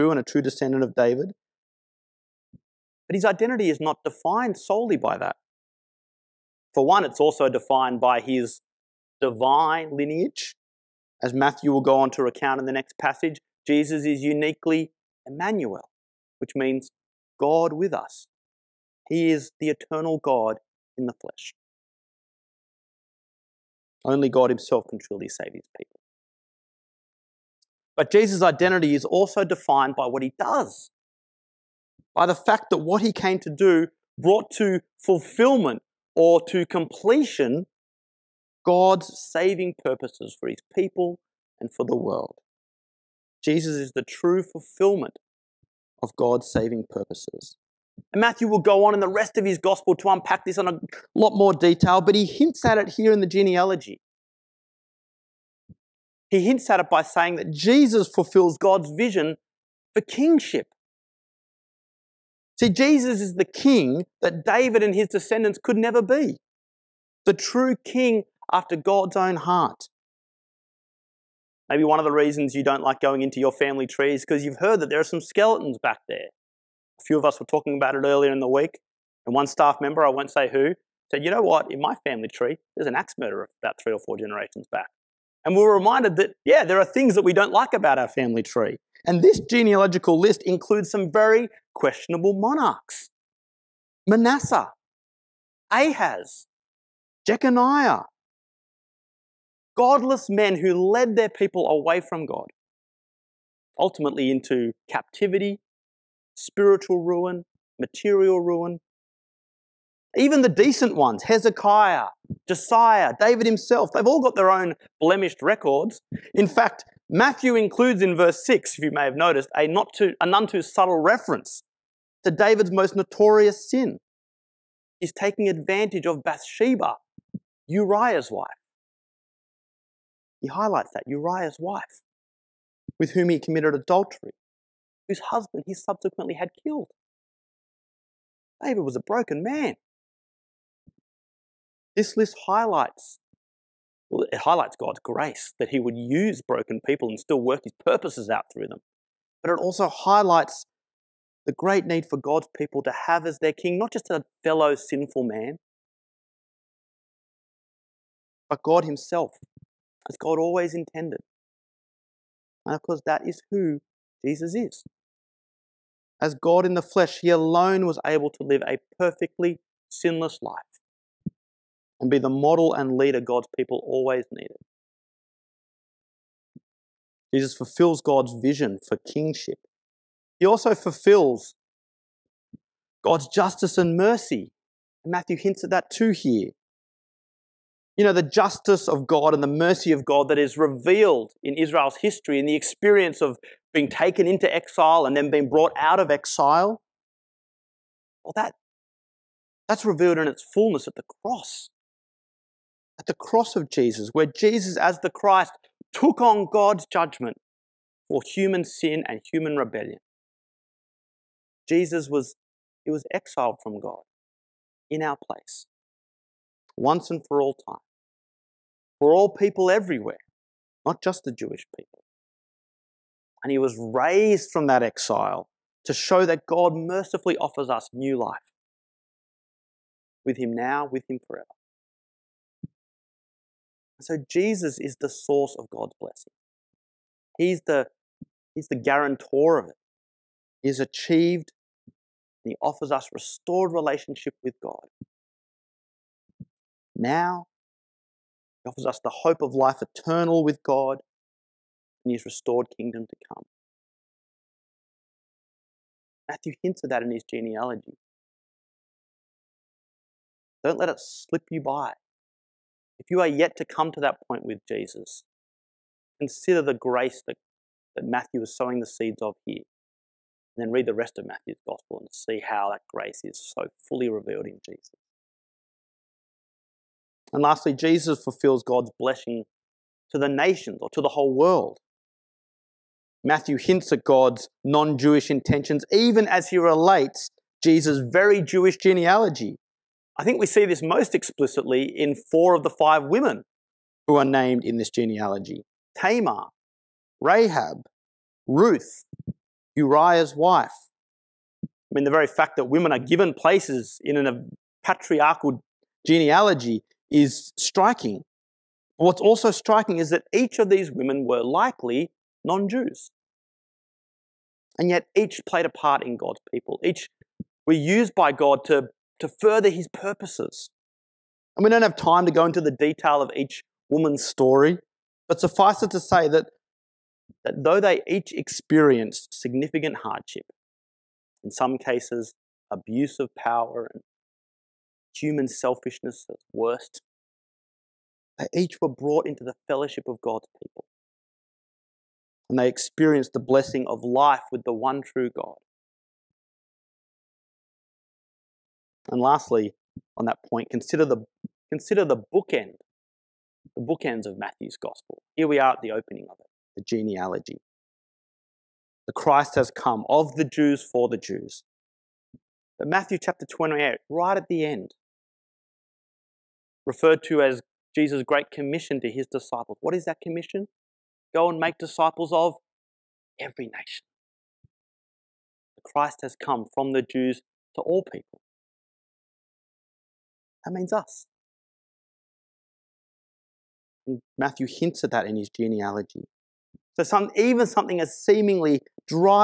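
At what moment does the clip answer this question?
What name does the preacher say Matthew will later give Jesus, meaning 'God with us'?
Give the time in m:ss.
0:15.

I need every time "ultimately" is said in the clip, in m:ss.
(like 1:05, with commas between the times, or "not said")
1:43.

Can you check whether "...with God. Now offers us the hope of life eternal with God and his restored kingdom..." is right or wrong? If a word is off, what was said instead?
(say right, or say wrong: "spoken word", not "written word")
right.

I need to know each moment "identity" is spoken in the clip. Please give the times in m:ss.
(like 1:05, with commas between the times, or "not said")
0:03, 0:28.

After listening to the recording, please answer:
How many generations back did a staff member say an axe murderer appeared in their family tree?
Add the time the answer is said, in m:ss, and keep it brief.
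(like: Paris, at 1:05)
3 or 4, at 1:23.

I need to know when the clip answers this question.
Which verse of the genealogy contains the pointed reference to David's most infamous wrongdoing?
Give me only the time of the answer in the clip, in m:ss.
1:58.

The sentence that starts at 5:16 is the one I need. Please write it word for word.
Each were used by God to, to further his purposes.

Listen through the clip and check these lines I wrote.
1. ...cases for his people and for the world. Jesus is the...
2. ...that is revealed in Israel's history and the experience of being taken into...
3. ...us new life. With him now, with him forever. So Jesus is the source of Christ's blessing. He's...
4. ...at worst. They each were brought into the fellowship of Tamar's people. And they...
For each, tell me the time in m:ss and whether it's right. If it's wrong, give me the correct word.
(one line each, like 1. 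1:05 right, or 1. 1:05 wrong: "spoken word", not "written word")
1. 0:39 wrong: "purposes", not "cases"
2. 3:10 right
3. 3:47 wrong: "God", not "Christ"
4. 5:36 wrong: "God", not "Tamar".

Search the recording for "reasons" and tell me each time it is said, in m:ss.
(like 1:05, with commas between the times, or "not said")
1:12.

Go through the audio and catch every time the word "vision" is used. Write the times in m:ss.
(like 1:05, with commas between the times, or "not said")
0:58, 2:58.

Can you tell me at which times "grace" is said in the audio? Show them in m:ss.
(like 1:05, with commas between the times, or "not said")
2:25, 4:26, 4:32.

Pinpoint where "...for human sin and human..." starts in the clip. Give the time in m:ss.
3:28.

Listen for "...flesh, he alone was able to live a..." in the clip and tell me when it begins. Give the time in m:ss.
2:46.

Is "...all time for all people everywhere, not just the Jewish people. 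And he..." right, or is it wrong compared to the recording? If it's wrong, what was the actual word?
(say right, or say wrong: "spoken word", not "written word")
right.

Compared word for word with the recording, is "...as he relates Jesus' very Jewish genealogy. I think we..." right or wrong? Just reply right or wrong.
right.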